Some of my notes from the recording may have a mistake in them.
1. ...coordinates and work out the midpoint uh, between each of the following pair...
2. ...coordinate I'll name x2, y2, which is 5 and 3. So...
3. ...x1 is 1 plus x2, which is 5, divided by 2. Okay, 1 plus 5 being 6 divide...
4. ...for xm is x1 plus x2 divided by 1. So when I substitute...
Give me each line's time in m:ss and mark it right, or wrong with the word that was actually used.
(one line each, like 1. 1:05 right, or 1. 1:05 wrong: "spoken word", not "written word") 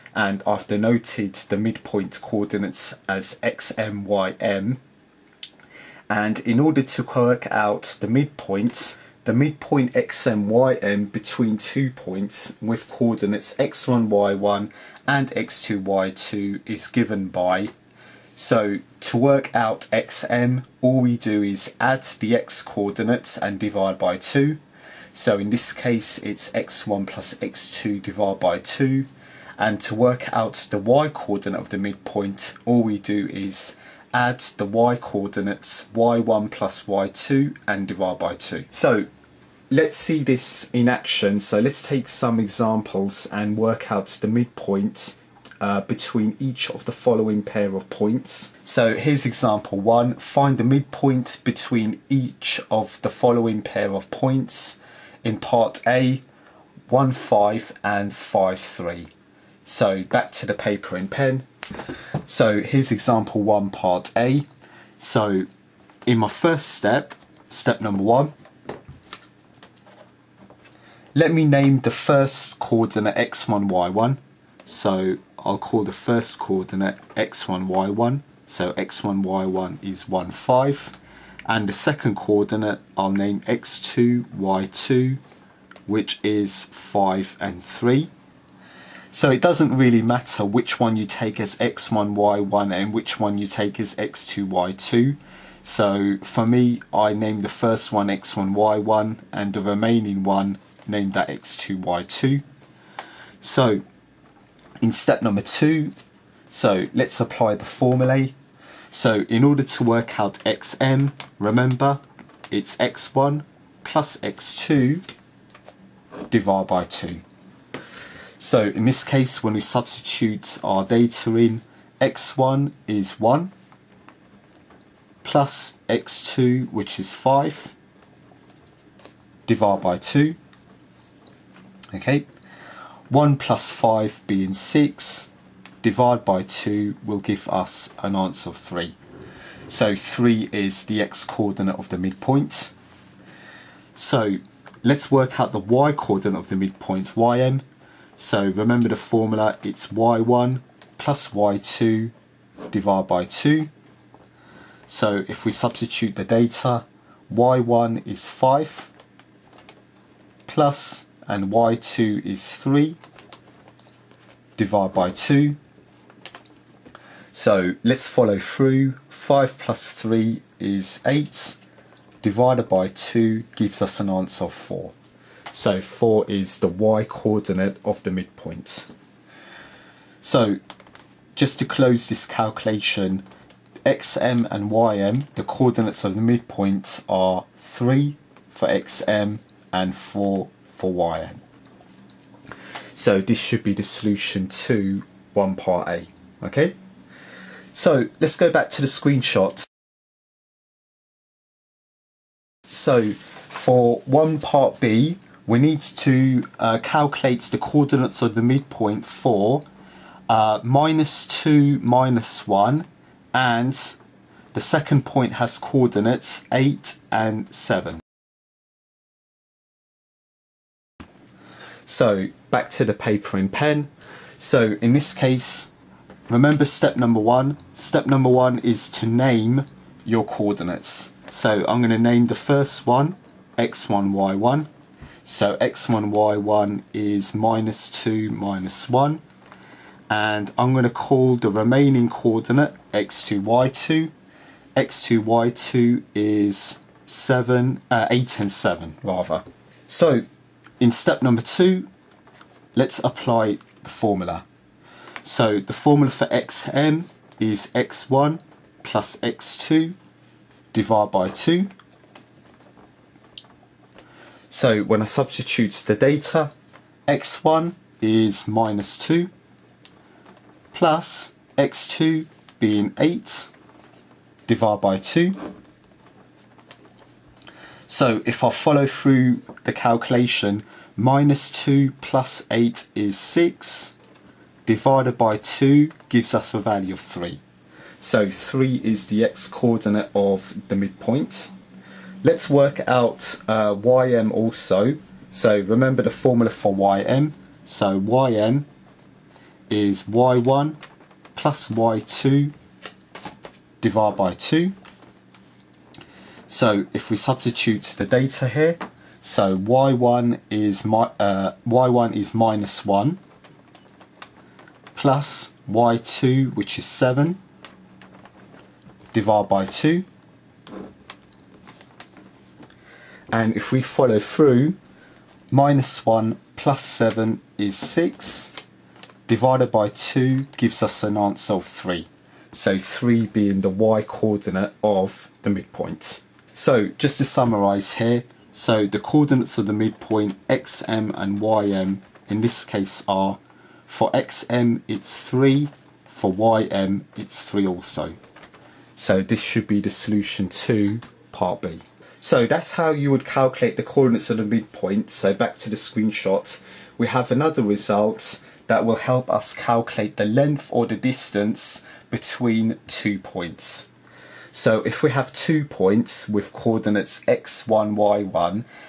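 1. 0:42 wrong: "examples", not "coordinates"
2. 1:22 right
3. 2:02 right
4. 4:16 wrong: "2", not "1".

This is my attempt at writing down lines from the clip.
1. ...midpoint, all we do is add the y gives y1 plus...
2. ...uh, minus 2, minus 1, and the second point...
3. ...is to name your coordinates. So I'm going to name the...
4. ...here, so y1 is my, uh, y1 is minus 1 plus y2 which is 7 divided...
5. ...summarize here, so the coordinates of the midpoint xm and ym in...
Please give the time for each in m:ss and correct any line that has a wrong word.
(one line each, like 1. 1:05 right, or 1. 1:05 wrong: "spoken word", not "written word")
1. 0:31 wrong: "coordinates", not "gives"
2. 3:30 right
3. 3:48 right
4. 5:08 right
5. 5:37 right.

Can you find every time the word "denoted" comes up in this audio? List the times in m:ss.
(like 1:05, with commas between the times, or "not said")
0:00.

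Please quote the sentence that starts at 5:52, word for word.
So that's how you would calculate the coordinates of the midpoint.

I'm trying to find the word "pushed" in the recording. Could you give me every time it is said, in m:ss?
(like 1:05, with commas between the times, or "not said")
not said.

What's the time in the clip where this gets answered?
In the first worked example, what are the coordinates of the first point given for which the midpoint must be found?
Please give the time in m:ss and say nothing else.
0:56.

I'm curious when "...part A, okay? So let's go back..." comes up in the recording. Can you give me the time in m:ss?
3:15.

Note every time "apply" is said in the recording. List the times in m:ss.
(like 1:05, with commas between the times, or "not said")
1:47, 4:13.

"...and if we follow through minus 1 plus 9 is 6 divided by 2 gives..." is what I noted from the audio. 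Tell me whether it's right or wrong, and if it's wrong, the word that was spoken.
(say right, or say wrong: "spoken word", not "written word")
wrong: "7", not "9".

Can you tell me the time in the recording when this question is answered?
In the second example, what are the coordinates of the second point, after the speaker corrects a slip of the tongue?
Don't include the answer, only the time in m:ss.
4:08.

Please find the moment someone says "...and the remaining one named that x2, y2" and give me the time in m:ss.
1:39.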